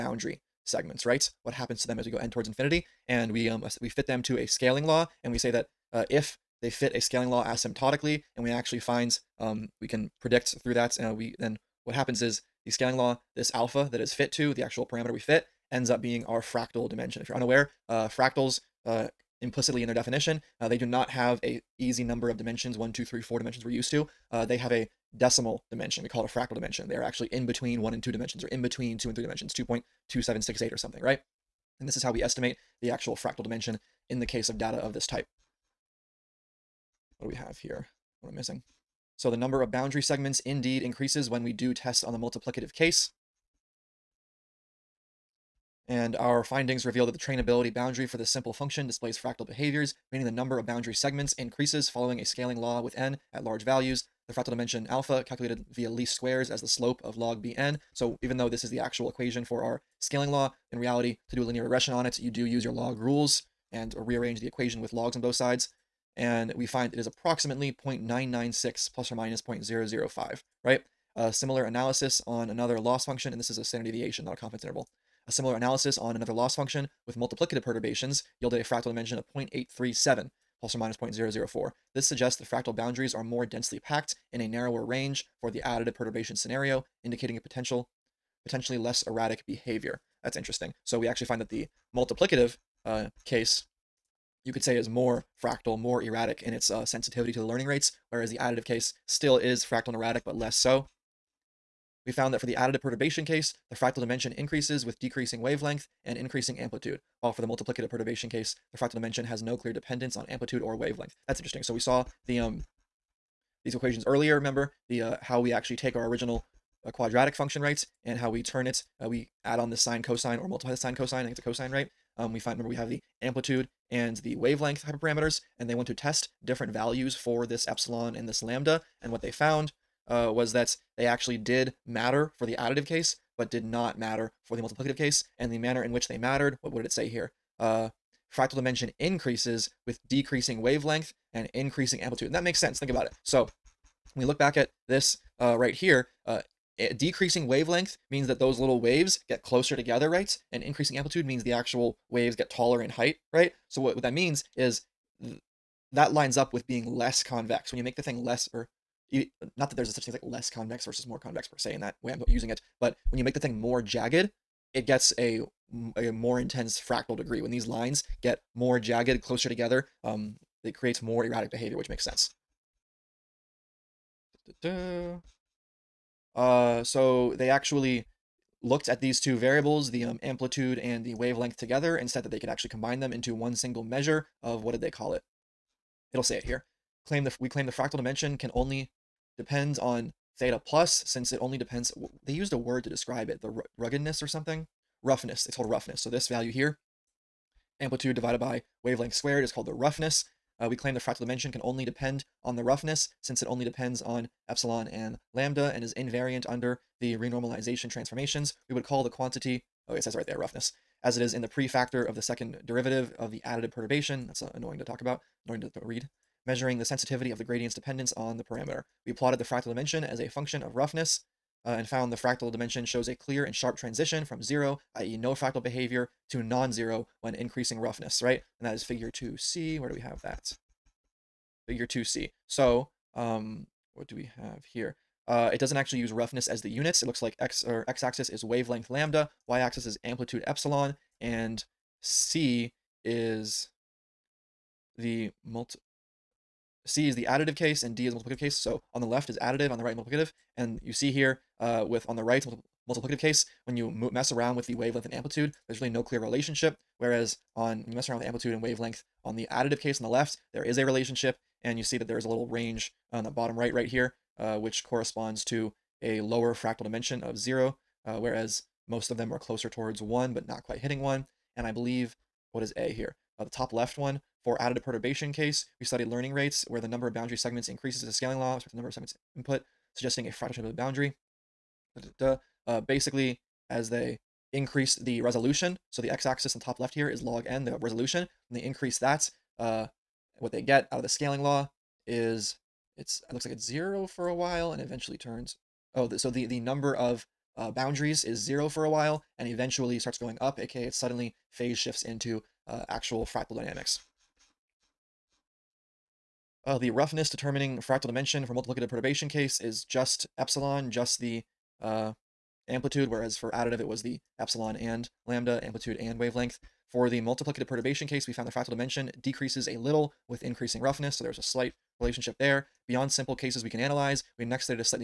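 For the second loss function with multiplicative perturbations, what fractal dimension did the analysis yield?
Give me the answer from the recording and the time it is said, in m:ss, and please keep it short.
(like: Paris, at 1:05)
0.837, at 1:19.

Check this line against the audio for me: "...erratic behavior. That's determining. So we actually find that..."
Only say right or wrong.
wrong.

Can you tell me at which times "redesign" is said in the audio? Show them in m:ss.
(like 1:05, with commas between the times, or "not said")
not said.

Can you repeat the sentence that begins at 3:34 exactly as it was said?
That's uh, annoying to talk about, annoying to, to read.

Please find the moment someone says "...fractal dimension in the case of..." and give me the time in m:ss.
0:33.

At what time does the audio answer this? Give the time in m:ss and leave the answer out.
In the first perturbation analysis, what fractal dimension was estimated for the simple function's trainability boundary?
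1:07.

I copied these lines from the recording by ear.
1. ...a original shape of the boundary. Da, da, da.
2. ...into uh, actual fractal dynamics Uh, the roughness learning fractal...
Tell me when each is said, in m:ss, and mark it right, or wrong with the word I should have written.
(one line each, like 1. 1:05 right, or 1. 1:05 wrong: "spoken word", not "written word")
1. 4:40 wrong: "fractal", not "original"
2. 5:02 wrong: "determining", not "learning".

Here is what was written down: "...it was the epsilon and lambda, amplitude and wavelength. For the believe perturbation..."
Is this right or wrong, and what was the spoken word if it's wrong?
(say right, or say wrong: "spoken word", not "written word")
wrong: "multiplicative", not "believe".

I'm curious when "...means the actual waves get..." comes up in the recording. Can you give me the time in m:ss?
2:31.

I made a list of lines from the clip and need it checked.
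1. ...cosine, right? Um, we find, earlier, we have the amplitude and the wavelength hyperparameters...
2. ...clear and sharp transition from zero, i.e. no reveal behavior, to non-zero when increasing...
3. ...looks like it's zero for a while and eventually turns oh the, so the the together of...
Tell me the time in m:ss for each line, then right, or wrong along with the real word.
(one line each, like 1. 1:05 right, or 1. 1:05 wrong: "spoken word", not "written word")
1. 2:01 wrong: "remember", not "earlier"
2. 3:43 wrong: "fractal", not "reveal"
3. 4:53 wrong: "number", not "together".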